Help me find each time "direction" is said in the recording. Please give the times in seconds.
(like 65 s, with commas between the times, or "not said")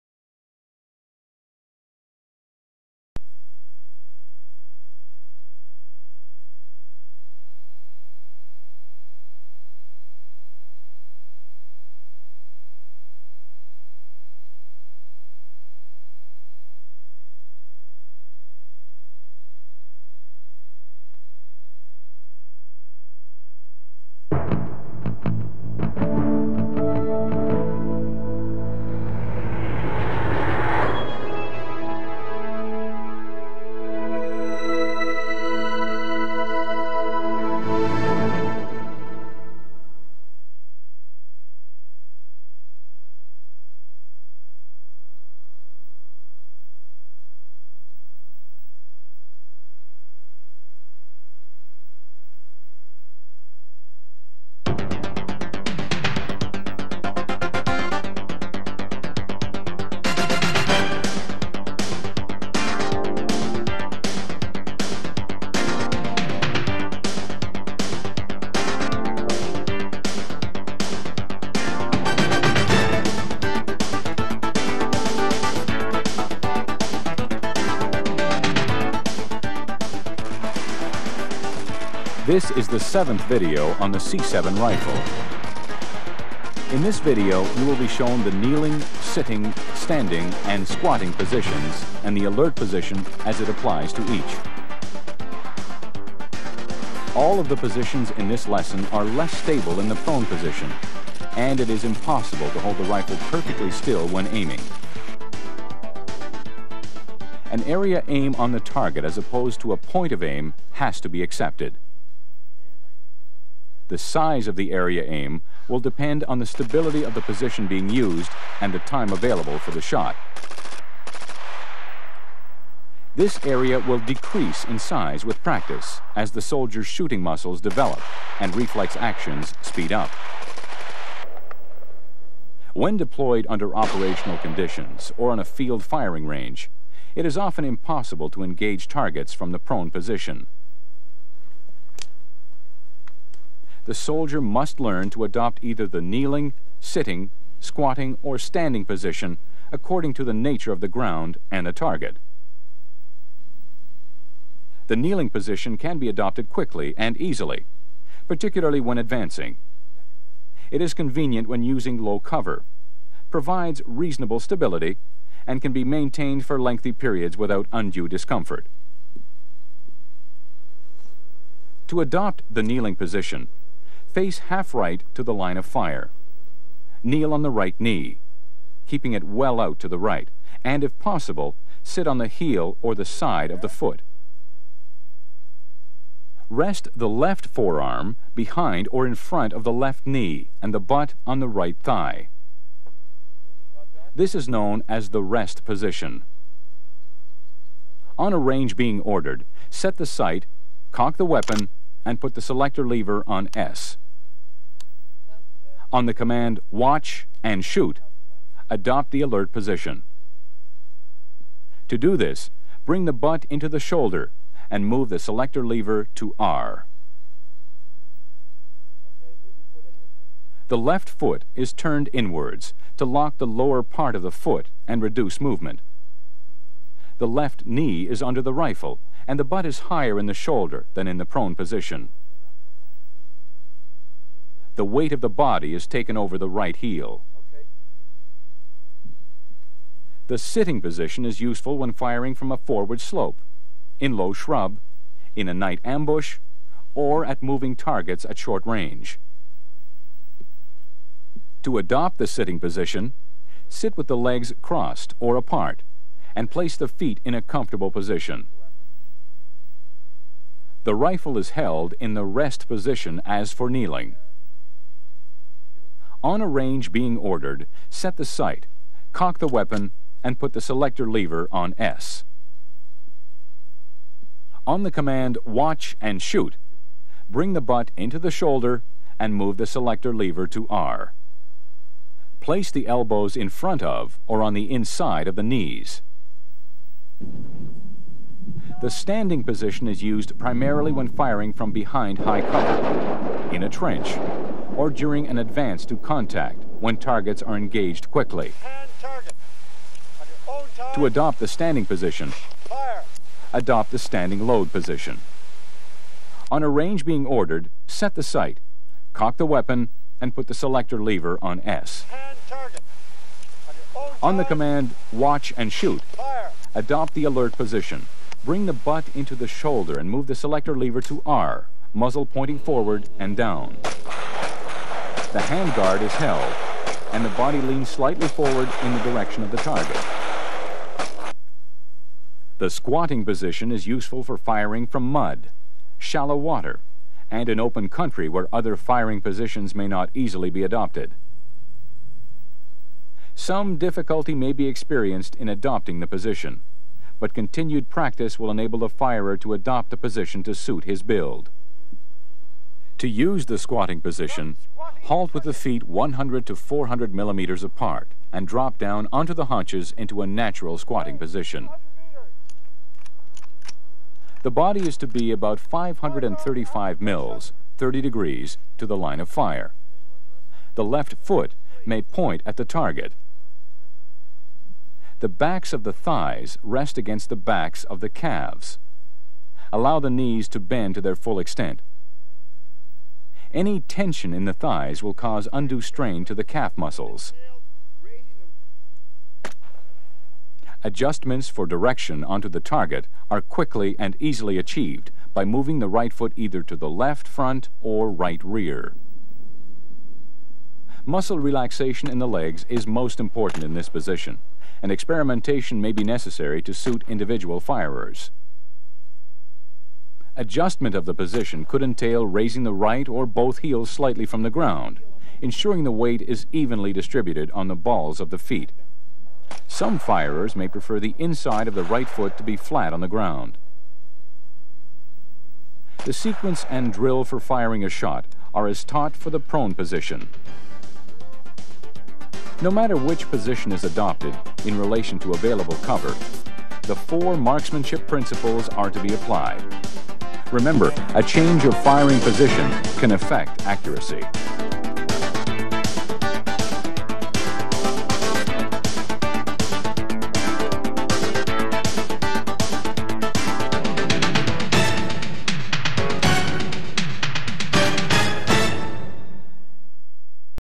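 329 s, 391 s.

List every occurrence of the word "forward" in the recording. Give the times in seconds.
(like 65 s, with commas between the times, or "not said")
242 s, 322 s, 328 s.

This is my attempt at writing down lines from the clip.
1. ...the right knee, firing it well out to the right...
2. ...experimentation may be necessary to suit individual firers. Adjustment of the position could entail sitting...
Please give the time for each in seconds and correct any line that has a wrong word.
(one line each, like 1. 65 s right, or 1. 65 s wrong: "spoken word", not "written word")
1. 177 s wrong: "keeping", not "firing"
2. 404 s wrong: "raising", not "sitting".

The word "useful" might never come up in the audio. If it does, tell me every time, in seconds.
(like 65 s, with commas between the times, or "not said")
241 s, 333 s.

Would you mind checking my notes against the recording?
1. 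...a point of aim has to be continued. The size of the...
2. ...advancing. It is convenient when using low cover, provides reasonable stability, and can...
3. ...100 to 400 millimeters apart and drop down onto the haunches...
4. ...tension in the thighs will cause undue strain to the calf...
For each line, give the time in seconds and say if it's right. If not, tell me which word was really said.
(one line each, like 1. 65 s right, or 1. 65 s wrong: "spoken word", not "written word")
1. 109 s wrong: "accepted", not "continued"
2. 158 s right
3. 355 s right
4. 383 s right.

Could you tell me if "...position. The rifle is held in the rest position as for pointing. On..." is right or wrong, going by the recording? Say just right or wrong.
wrong.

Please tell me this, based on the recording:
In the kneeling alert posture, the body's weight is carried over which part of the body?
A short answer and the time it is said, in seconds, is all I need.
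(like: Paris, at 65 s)
the right heel, at 236 s.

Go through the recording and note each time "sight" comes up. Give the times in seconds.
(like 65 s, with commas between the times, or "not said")
200 s, 268 s, 308 s.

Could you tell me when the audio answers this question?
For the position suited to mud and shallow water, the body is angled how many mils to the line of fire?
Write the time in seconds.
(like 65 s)
365 s.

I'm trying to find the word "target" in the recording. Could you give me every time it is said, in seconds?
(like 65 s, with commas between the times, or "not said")
108 s, 138 s, 151 s, 247 s, 296 s, 329 s, 372 s, 392 s.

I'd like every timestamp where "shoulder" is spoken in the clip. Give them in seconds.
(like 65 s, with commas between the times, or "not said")
213 s, 230 s, 278 s, 319 s.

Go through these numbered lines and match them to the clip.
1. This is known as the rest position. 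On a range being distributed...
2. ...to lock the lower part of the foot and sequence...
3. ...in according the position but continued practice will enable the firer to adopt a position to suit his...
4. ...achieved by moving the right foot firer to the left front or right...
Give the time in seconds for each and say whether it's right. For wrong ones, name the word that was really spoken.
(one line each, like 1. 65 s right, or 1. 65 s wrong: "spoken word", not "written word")
1. 194 s wrong: "ordered", not "distributed"
2. 222 s wrong: "reduce", not "sequence"
3. 345 s wrong: "adopting", not "according"
4. 394 s wrong: "either", not "firer".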